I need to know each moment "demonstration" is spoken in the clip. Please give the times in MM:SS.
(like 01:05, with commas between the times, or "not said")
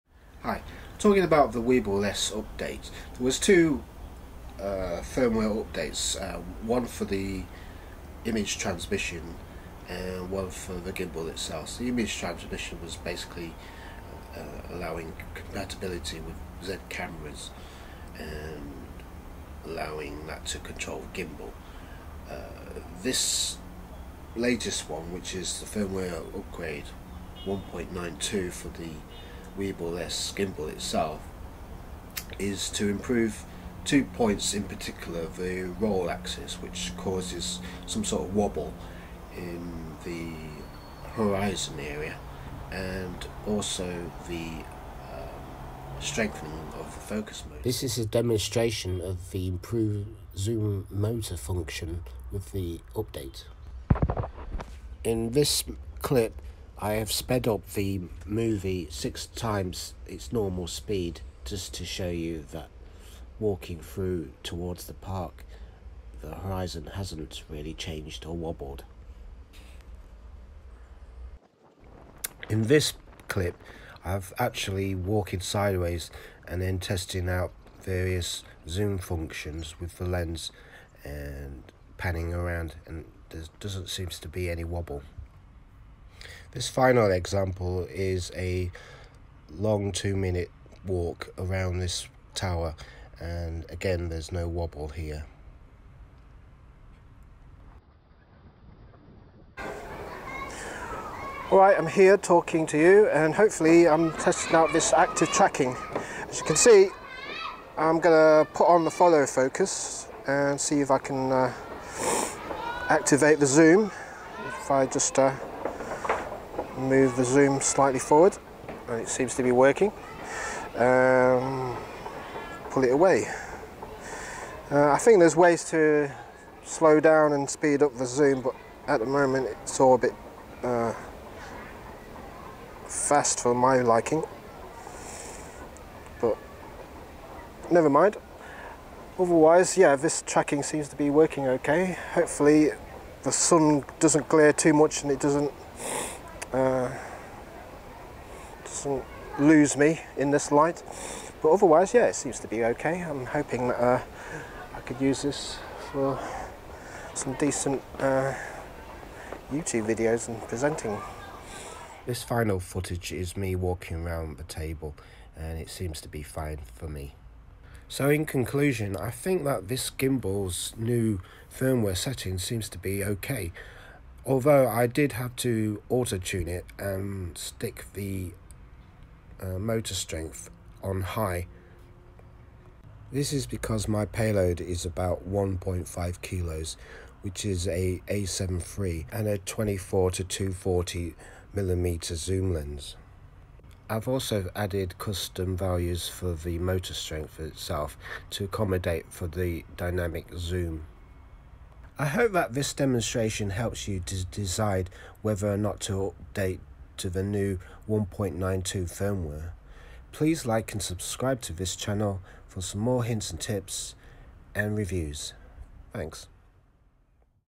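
00:48, 03:22.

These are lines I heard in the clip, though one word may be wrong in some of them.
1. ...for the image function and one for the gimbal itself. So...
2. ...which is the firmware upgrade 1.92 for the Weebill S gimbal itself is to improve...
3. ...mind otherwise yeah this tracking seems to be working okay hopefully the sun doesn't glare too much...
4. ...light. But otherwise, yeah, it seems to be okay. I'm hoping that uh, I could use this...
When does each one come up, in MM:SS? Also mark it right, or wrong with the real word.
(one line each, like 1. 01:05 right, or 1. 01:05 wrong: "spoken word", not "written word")
1. 00:06 wrong: "transmission", not "function"
2. 00:25 right
3. 02:17 right
4. 02:30 right.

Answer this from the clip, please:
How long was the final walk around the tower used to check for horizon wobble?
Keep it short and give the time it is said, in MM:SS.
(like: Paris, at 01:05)
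2 minutes, at 01:29.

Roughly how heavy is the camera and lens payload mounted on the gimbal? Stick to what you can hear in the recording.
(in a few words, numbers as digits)
1.5 kilos.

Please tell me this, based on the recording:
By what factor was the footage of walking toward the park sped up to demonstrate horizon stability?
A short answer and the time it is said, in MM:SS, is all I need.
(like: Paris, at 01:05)
6 times, at 00:58.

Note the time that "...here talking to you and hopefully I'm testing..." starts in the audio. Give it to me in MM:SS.
01:41.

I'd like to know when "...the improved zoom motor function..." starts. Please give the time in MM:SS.
00:49.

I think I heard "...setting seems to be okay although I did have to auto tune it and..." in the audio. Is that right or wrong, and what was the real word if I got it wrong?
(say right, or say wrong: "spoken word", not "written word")
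right.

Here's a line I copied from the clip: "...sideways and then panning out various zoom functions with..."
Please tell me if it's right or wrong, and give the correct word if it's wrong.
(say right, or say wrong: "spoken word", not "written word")
wrong: "testing", not "panning".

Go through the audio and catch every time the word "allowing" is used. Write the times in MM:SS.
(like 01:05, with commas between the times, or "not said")
00:14, 00:19.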